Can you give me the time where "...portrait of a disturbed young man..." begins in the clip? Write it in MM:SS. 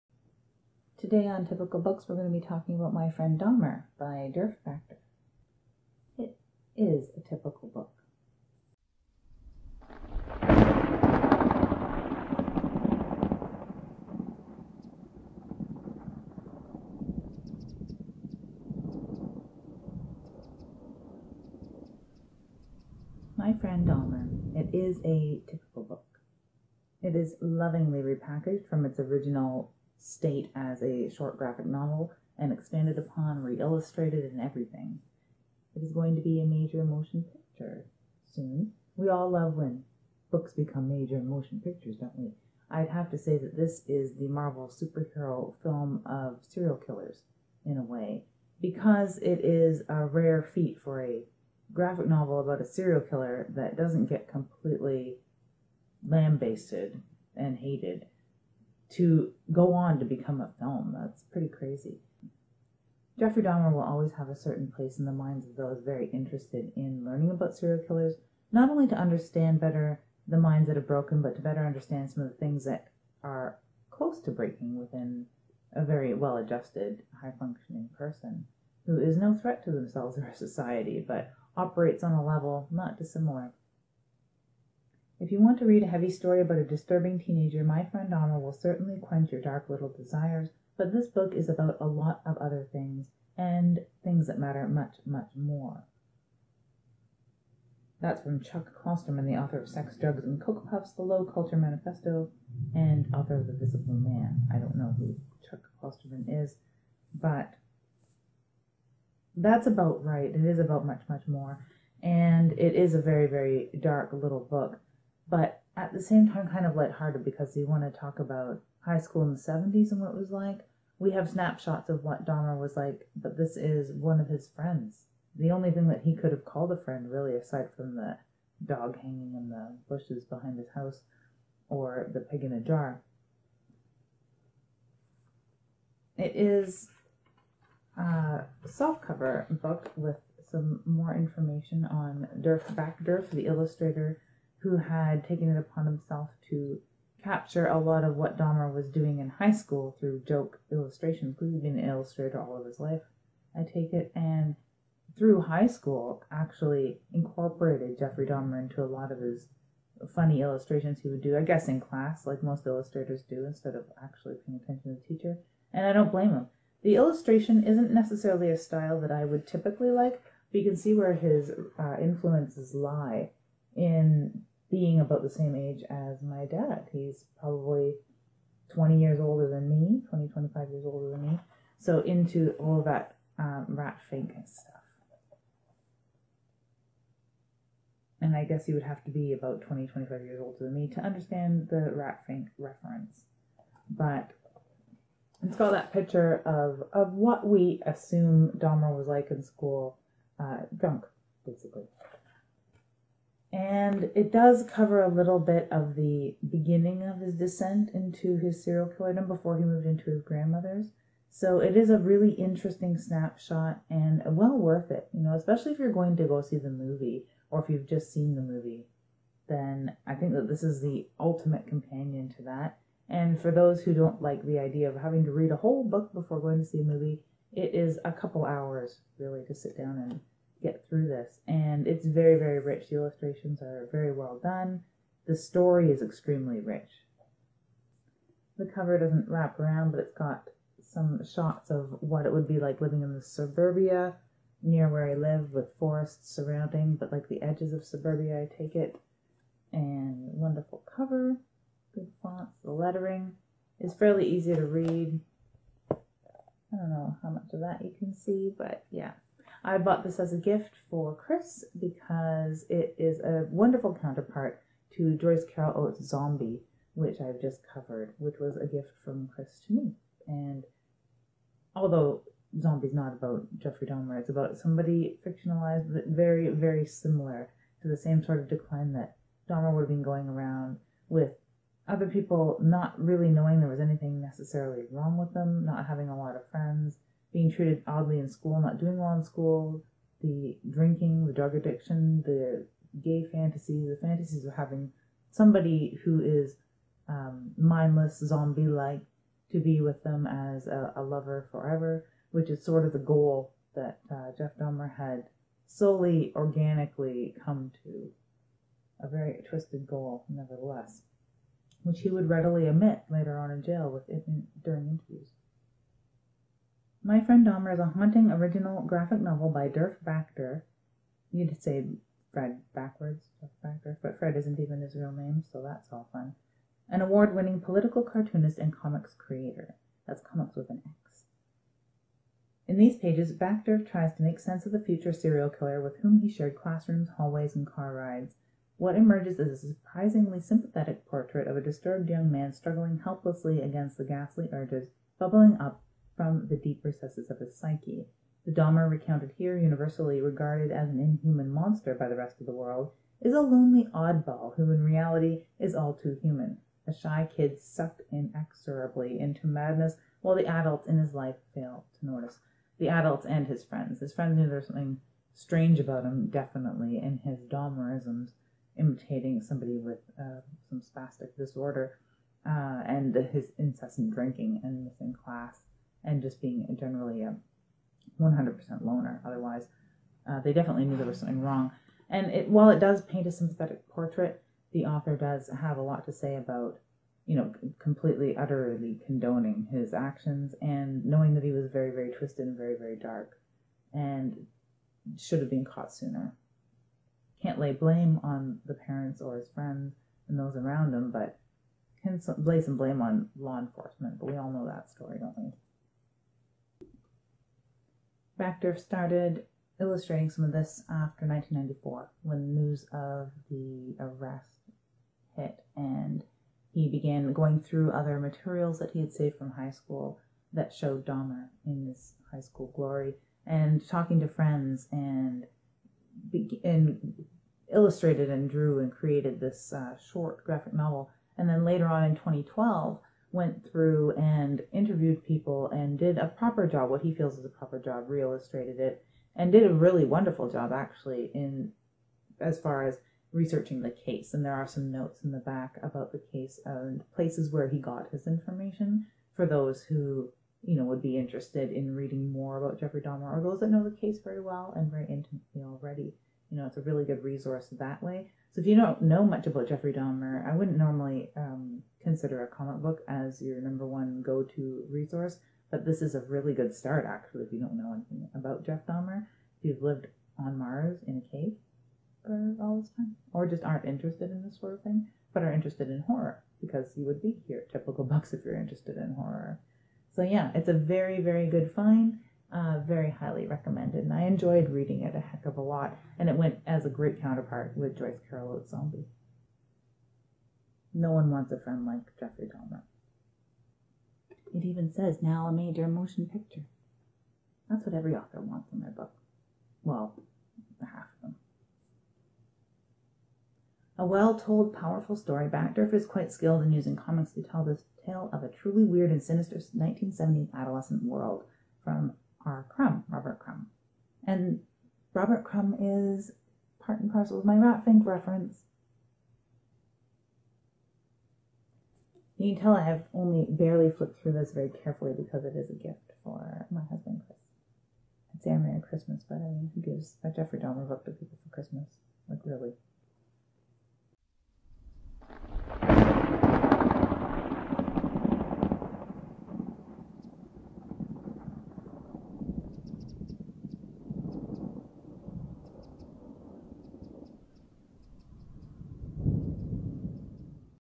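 05:41.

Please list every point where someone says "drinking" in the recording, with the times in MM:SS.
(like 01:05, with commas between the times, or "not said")
04:50, 06:14.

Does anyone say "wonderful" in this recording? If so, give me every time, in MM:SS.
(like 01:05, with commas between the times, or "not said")
04:10, 04:23, 07:20.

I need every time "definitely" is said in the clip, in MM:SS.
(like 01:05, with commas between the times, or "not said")
06:06, 06:20.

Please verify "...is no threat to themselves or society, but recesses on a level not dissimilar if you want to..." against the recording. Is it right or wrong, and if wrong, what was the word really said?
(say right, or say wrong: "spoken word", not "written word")
wrong: "operates", not "recesses".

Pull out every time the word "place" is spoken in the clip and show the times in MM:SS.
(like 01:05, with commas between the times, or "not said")
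01:04, 07:27.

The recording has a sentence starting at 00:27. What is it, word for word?
It is lovingly repackaged from its original state as a short graphic novel and expanded upon, re illustrated, and everything.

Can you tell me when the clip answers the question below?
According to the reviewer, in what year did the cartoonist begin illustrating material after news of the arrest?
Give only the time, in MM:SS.
06:51.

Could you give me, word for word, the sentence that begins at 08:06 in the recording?
And it went as a great counterpart with Joyce Carol Oates' Zombie.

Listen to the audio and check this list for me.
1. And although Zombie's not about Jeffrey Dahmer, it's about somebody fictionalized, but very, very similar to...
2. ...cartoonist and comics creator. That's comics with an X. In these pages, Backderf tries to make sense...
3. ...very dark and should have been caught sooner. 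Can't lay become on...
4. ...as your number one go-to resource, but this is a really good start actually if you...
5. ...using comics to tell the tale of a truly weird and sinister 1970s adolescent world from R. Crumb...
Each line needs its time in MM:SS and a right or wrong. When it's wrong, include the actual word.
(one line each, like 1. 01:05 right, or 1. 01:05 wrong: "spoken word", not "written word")
1. 04:30 right
2. 05:28 right
3. 06:32 wrong: "blame", not "become"
4. 07:43 right
5. 08:26 right.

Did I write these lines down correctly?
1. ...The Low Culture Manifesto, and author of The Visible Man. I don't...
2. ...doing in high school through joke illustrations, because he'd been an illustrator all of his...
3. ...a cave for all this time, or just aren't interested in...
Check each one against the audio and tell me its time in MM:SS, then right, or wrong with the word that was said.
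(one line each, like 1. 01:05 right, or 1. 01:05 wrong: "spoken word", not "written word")
1. 01:40 right
2. 02:28 right
3. 07:51 right.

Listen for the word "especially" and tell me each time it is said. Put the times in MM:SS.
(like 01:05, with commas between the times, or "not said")
03:35.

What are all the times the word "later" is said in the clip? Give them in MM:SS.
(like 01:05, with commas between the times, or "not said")
05:13, 07:11.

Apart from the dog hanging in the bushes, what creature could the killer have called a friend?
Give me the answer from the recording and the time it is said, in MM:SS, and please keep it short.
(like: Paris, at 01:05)
the pig in a jar, at 02:12.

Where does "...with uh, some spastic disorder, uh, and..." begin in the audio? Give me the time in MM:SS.
06:09.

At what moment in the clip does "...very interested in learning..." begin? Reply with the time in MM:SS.
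01:05.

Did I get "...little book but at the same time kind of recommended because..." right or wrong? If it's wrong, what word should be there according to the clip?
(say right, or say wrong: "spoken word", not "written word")
wrong: "lighthearted", not "recommended".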